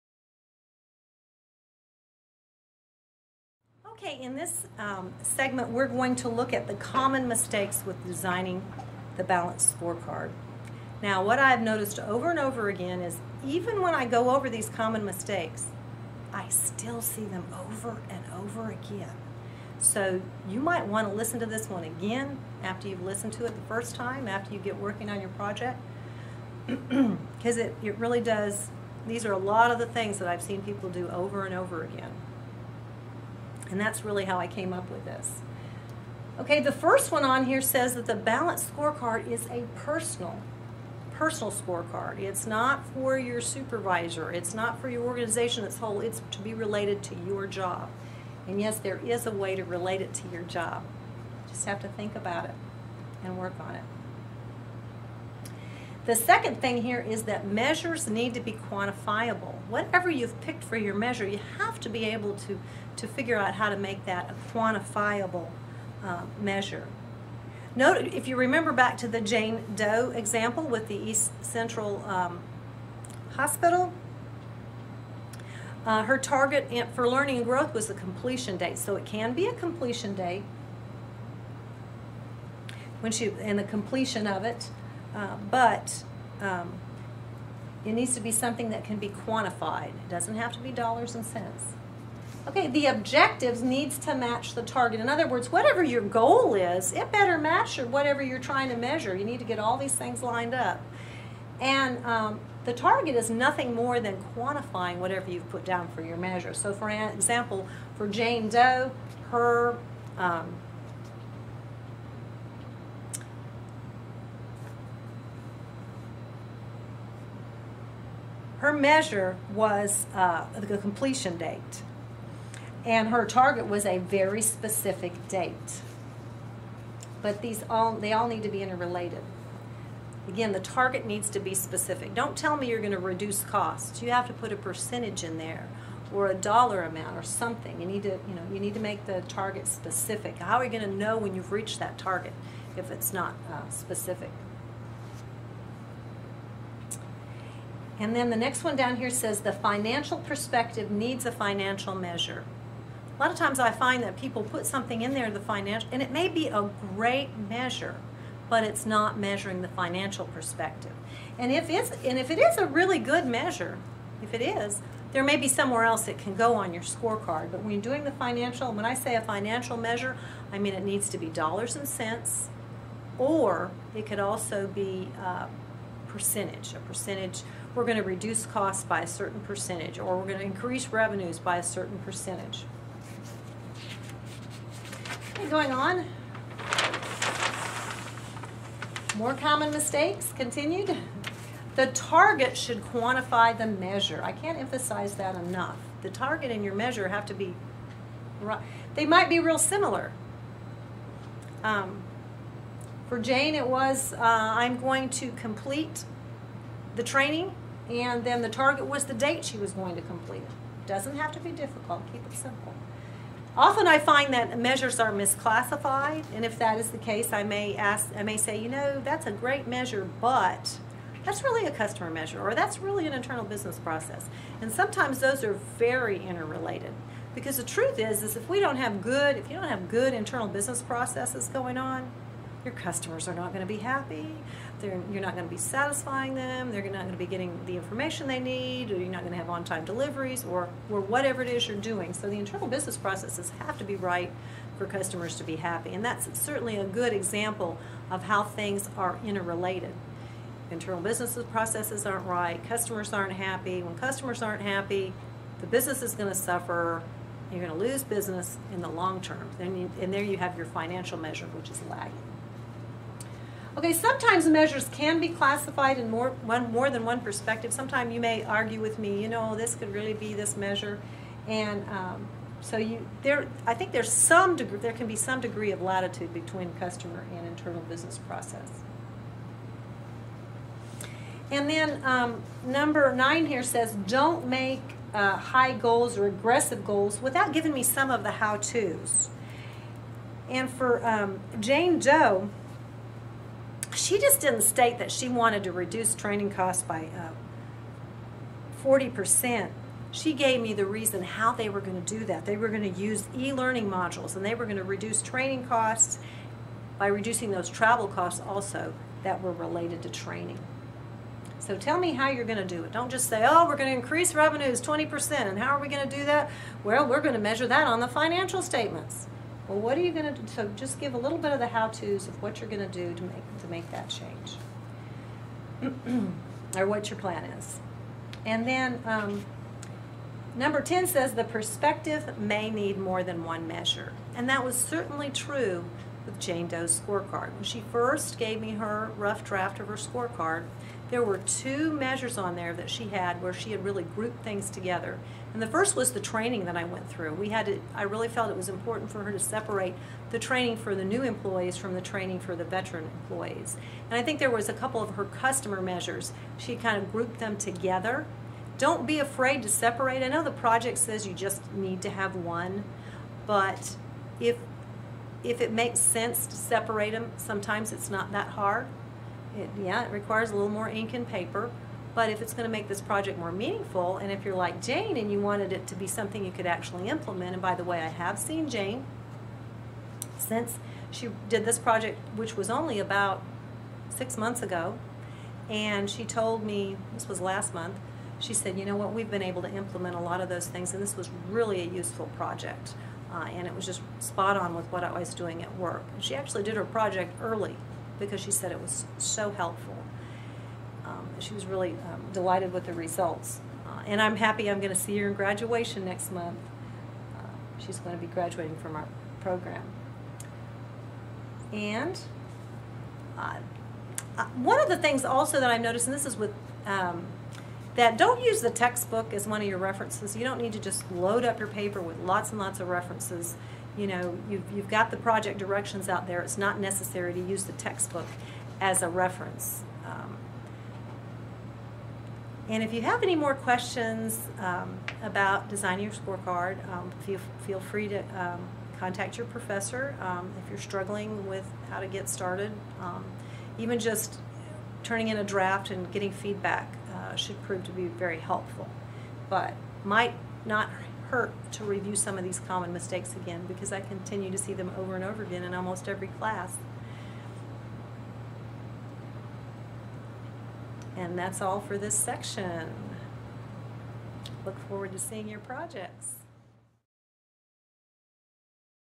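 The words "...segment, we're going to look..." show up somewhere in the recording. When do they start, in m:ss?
0:05.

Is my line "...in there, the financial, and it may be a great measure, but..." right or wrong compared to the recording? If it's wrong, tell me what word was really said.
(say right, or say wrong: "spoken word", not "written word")
right.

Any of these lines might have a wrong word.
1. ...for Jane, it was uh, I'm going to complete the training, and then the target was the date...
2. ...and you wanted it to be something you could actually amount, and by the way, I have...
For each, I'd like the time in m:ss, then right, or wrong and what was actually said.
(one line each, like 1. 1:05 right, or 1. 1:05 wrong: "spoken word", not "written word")
1. 3:23 right
2. 6:15 wrong: "implement", not "amount".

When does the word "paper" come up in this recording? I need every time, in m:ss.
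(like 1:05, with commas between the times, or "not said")
6:11, 7:01.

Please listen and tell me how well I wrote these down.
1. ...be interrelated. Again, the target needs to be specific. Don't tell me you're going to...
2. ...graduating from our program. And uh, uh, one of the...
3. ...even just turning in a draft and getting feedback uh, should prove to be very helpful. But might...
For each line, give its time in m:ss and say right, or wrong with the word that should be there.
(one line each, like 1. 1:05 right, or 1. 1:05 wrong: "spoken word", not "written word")
1. 2:08 right
2. 6:48 right
3. 7:23 right.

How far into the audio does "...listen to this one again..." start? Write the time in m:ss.
0:21.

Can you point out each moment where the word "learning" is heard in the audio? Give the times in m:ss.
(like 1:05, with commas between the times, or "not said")
1:17, 5:03.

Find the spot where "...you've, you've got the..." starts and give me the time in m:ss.
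7:04.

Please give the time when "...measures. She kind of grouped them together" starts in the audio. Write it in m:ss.
5:55.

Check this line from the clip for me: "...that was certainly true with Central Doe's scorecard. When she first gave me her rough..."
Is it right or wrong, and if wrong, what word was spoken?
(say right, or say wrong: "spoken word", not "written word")
wrong: "Jane", not "Central".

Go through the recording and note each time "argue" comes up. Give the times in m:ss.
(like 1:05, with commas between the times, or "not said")
4:28.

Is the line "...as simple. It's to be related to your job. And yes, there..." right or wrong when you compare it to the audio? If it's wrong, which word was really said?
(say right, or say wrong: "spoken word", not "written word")
wrong: "whole", not "simple".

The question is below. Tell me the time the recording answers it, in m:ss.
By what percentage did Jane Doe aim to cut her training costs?
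4:58.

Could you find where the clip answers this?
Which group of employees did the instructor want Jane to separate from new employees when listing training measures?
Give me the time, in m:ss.
5:52.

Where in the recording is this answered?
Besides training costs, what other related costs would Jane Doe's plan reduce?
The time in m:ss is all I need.
5:07.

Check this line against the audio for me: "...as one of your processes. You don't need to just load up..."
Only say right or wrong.
wrong.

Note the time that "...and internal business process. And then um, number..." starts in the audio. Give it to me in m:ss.
4:37.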